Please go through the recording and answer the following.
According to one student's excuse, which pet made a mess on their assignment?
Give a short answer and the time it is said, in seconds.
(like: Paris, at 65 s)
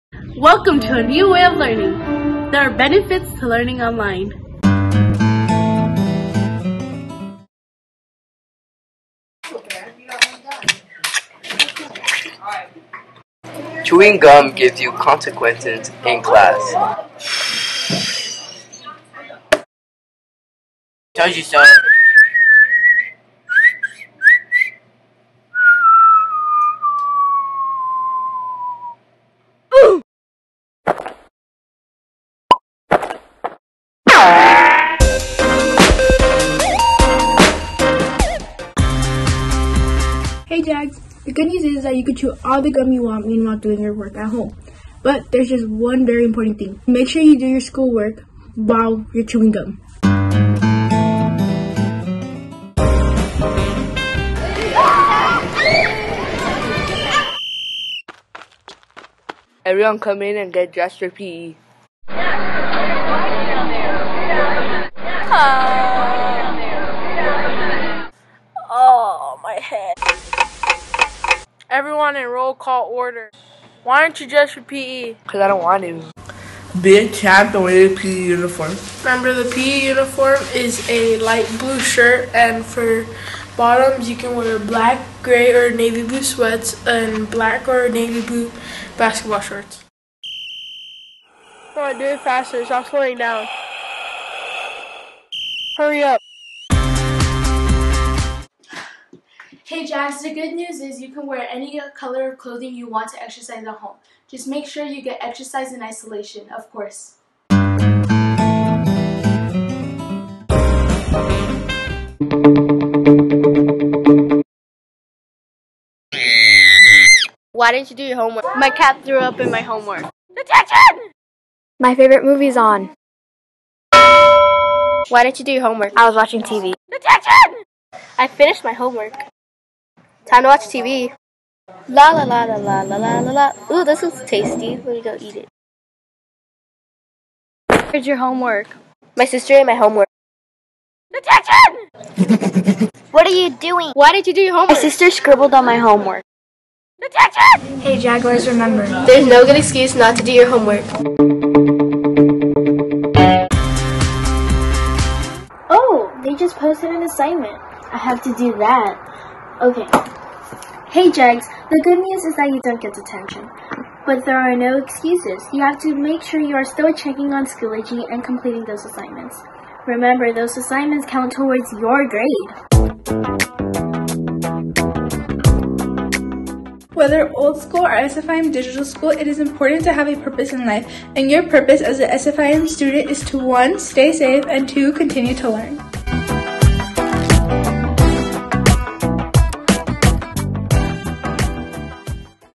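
cat, at 118 s.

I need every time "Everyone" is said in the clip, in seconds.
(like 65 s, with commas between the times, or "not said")
59 s.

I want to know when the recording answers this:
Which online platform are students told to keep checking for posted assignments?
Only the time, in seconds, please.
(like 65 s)
167 s.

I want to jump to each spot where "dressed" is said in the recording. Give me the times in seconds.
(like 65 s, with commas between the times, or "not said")
60 s, 74 s.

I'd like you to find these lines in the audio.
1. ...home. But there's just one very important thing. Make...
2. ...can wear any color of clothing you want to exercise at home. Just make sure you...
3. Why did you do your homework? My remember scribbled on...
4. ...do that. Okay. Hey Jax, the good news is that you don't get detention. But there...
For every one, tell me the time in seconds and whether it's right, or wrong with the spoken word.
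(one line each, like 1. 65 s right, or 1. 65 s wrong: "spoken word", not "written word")
1. 44 s right
2. 101 s right
3. 143 s wrong: "sister", not "remember"
4. 158 s wrong: "Jags", not "Jax".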